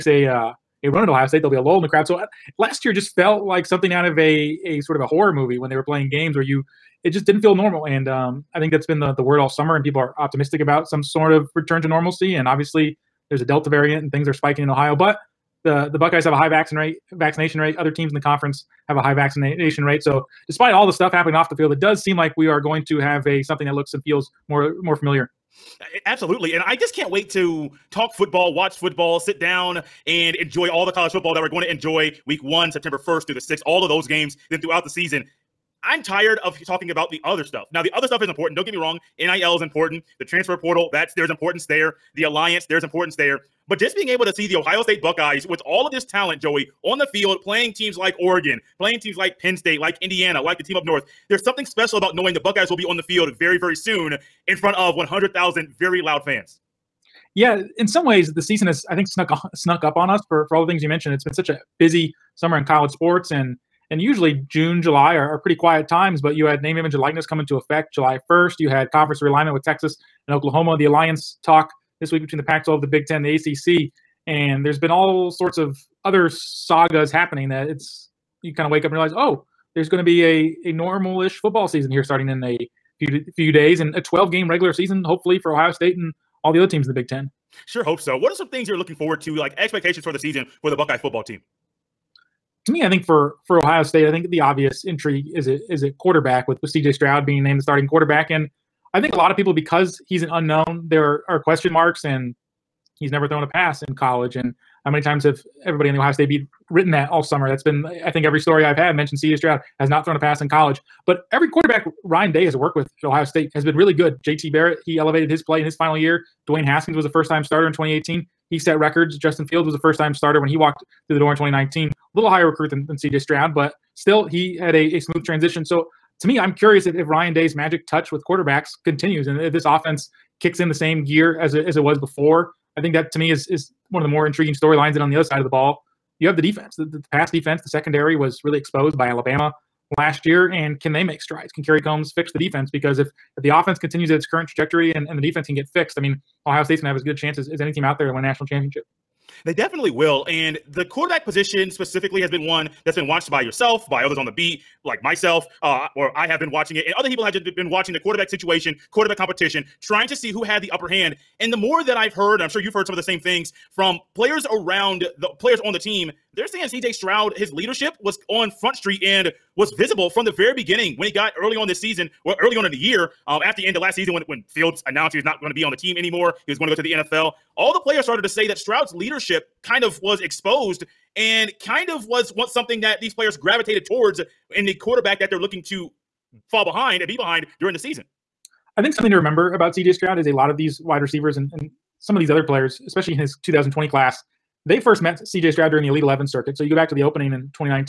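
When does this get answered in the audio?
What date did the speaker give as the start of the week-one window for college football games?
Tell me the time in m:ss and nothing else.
0:32.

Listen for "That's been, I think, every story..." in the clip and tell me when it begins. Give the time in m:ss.
1:47.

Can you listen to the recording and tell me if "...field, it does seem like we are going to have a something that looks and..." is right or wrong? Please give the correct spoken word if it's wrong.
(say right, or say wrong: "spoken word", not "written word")
right.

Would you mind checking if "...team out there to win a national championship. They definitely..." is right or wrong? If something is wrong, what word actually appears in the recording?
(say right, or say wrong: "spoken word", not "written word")
right.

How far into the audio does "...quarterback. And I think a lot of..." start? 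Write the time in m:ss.
1:37.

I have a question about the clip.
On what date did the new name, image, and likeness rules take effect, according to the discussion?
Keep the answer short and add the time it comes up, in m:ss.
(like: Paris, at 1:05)
July 1st, at 1:07.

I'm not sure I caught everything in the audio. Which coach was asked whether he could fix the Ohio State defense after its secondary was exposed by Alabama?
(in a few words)
Kerry Coombs.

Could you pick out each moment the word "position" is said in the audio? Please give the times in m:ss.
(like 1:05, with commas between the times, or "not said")
2:31.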